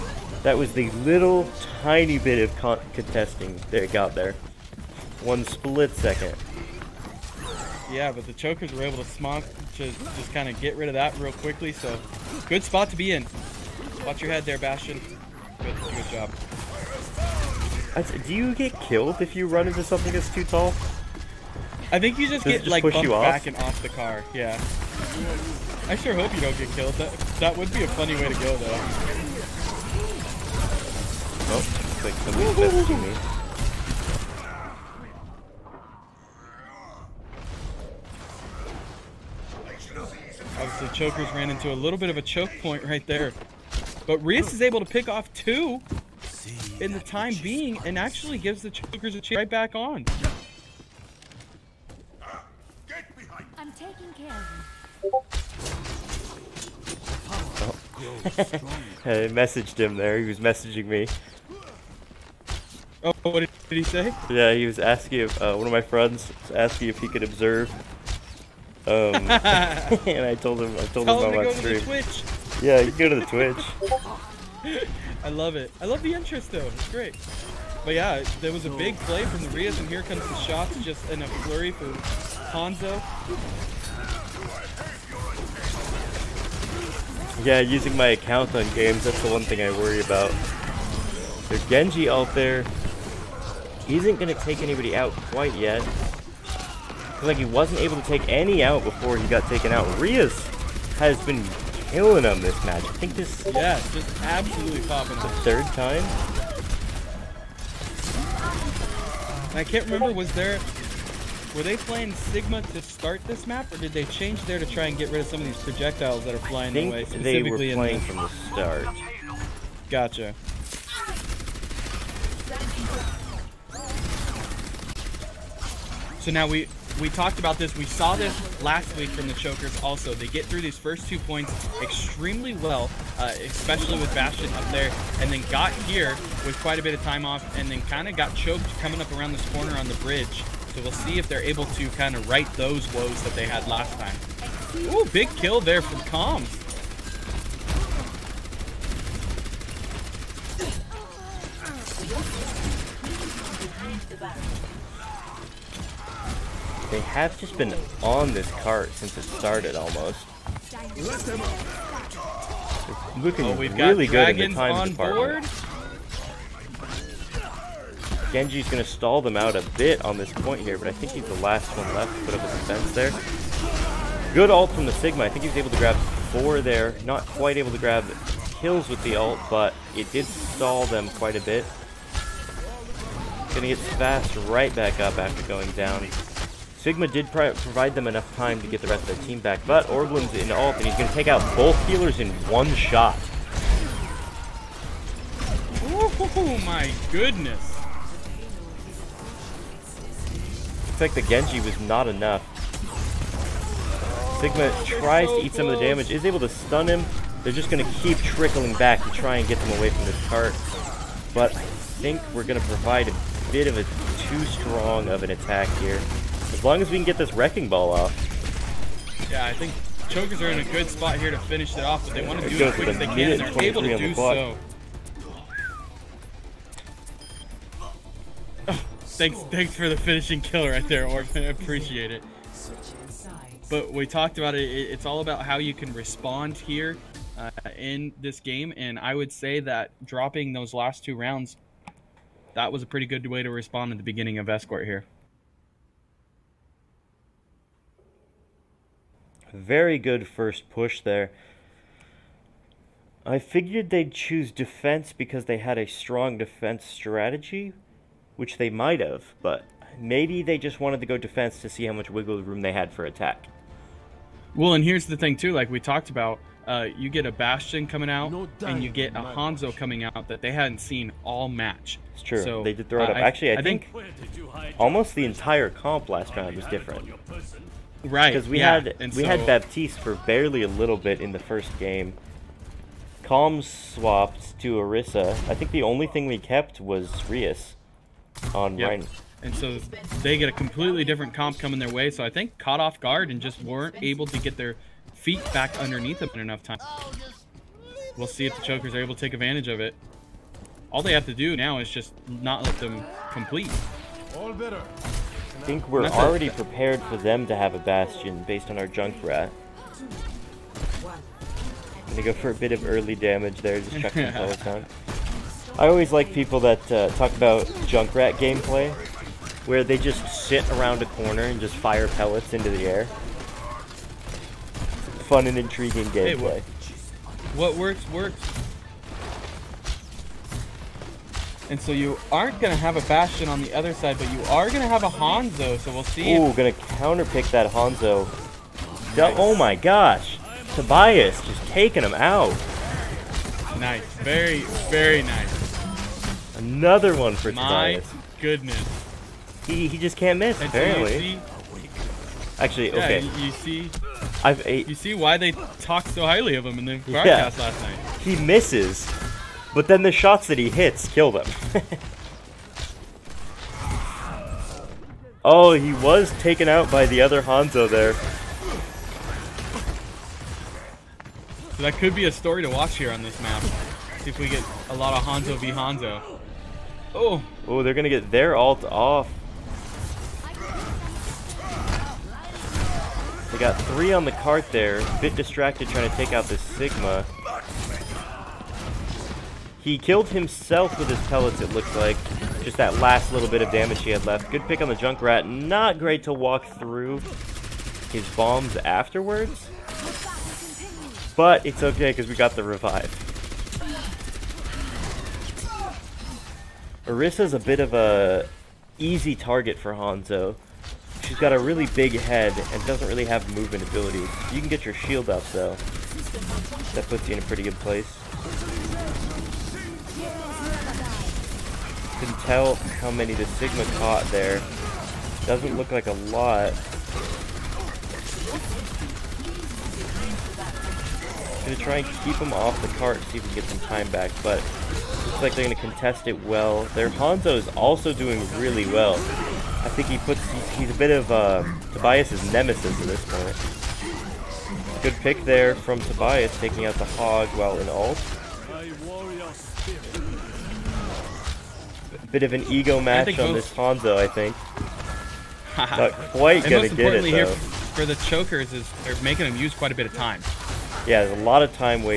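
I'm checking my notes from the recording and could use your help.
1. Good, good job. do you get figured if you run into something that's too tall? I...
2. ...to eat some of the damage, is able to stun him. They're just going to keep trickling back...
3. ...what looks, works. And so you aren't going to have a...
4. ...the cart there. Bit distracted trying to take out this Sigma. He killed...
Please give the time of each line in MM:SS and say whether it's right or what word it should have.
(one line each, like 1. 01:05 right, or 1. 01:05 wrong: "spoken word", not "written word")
1. 00:15 wrong: "killed", not "figured"
2. 03:25 right
3. 05:27 wrong: "works", not "looks"
4. 06:24 right.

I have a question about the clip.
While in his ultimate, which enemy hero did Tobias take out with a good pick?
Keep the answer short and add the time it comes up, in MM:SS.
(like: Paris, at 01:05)
Hog, at 07:27.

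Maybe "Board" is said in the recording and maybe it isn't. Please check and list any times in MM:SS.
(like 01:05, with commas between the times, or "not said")
02:44.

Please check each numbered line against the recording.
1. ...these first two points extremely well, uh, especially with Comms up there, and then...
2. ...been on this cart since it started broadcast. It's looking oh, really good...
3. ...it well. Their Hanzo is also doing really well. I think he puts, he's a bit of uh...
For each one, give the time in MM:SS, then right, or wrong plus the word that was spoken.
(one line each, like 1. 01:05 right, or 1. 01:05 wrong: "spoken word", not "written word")
1. 02:10 wrong: "Bastion", not "Comms"
2. 02:37 wrong: "almost", not "broadcast"
3. 07:16 right.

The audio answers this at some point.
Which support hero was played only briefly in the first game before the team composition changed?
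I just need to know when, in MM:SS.
04:39.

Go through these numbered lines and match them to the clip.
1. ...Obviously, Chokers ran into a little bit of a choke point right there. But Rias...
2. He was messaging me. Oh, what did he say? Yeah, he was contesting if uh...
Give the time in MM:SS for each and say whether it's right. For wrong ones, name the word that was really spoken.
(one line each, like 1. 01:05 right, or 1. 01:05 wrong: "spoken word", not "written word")
1. 00:40 right
2. 01:00 wrong: "asking", not "contesting".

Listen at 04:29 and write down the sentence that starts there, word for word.
coming out that they hadn't seen all match.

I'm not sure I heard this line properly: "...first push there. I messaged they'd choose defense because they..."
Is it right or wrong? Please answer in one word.
wrong.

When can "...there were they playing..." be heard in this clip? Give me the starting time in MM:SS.
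01:50.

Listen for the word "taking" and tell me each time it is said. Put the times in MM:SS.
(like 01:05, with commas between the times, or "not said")
00:53, 05:41, 07:26.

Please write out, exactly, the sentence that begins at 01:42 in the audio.
I think this yeah, just absolutely popping.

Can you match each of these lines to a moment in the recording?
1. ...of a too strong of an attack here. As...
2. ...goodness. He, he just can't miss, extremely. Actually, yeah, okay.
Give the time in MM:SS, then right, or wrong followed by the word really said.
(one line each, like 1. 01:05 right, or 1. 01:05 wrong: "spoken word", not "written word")
1. 03:33 right
2. 05:48 wrong: "apparently", not "extremely".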